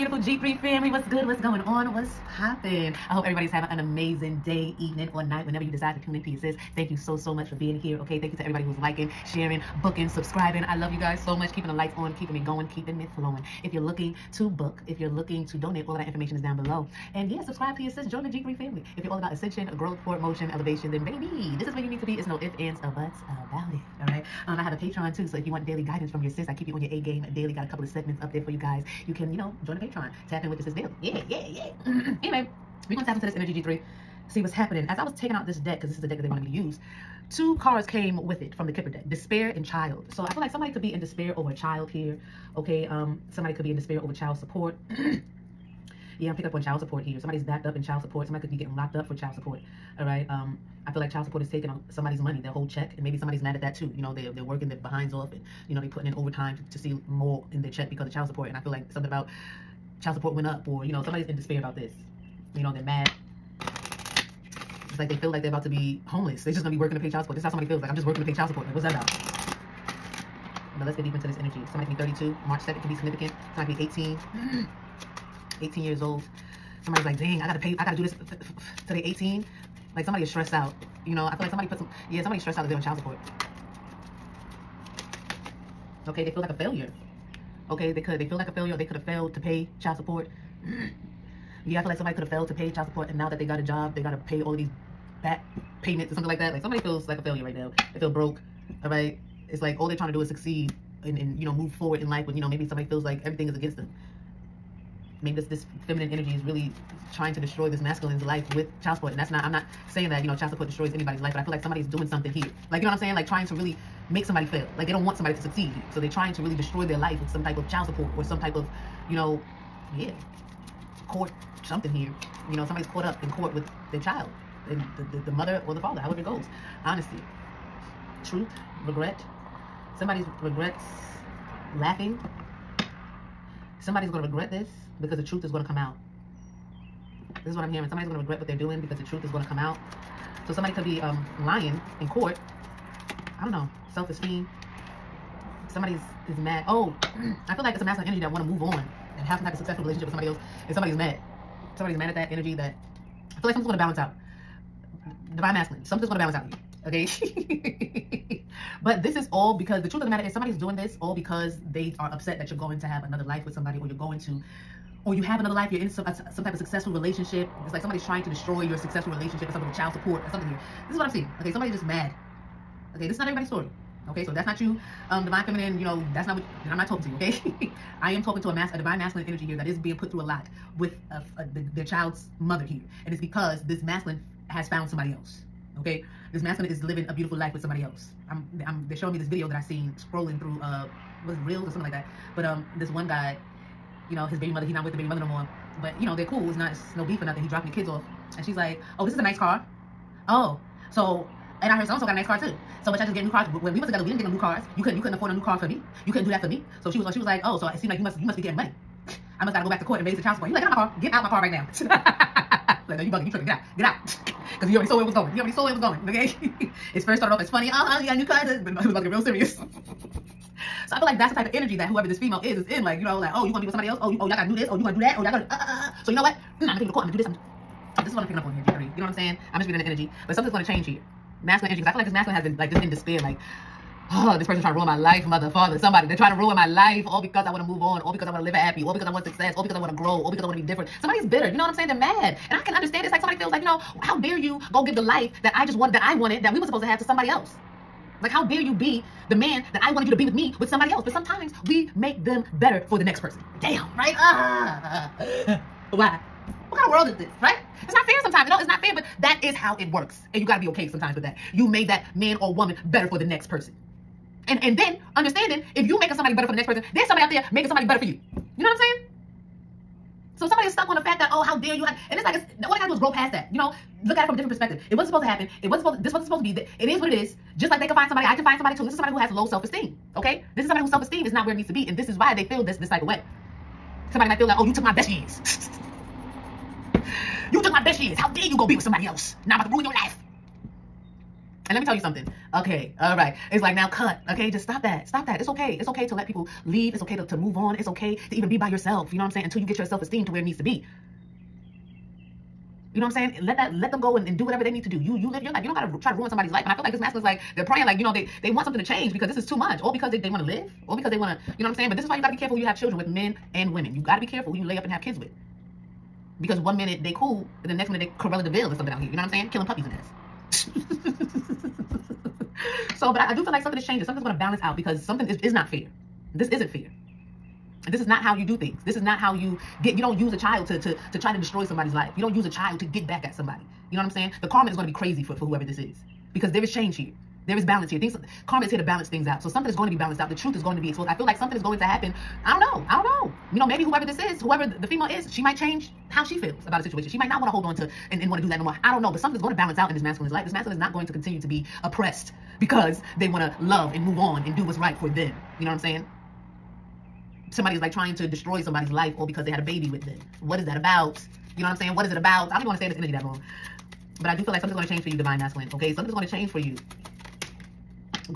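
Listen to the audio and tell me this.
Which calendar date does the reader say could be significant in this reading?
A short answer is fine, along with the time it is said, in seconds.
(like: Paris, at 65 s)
March 2, at 72 s.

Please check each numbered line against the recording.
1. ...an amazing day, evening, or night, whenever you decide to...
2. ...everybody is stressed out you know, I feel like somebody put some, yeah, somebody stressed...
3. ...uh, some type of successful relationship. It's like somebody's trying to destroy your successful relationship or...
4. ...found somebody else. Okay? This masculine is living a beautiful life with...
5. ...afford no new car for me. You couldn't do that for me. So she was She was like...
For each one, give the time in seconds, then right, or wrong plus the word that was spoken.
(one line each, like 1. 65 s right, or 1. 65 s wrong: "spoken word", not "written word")
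1. 3 s right
2. 80 s wrong: "somebody", not "everybody"
3. 166 s right
4. 184 s right
5. 205 s right.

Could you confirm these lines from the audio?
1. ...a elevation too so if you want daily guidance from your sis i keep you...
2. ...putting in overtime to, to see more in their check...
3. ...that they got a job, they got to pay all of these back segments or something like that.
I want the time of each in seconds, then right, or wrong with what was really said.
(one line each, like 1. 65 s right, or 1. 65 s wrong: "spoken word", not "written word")
1. 24 s wrong: "patreon", not "elevation"
2. 55 s right
3. 93 s wrong: "payments", not "segments".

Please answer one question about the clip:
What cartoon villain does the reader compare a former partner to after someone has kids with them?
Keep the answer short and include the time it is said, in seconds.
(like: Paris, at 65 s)
Cruella de Vil, at 318 s.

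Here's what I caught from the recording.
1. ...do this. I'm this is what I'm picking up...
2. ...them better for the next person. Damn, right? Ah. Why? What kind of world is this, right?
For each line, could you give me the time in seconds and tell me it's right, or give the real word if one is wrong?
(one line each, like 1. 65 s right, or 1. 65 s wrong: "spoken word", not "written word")
1. 227 s right
2. 252 s right.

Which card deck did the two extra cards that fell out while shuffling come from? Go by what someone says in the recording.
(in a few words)
Kipper.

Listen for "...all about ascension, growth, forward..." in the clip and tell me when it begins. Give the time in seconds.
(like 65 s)
19 s.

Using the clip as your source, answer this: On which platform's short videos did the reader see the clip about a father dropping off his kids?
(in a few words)
reels.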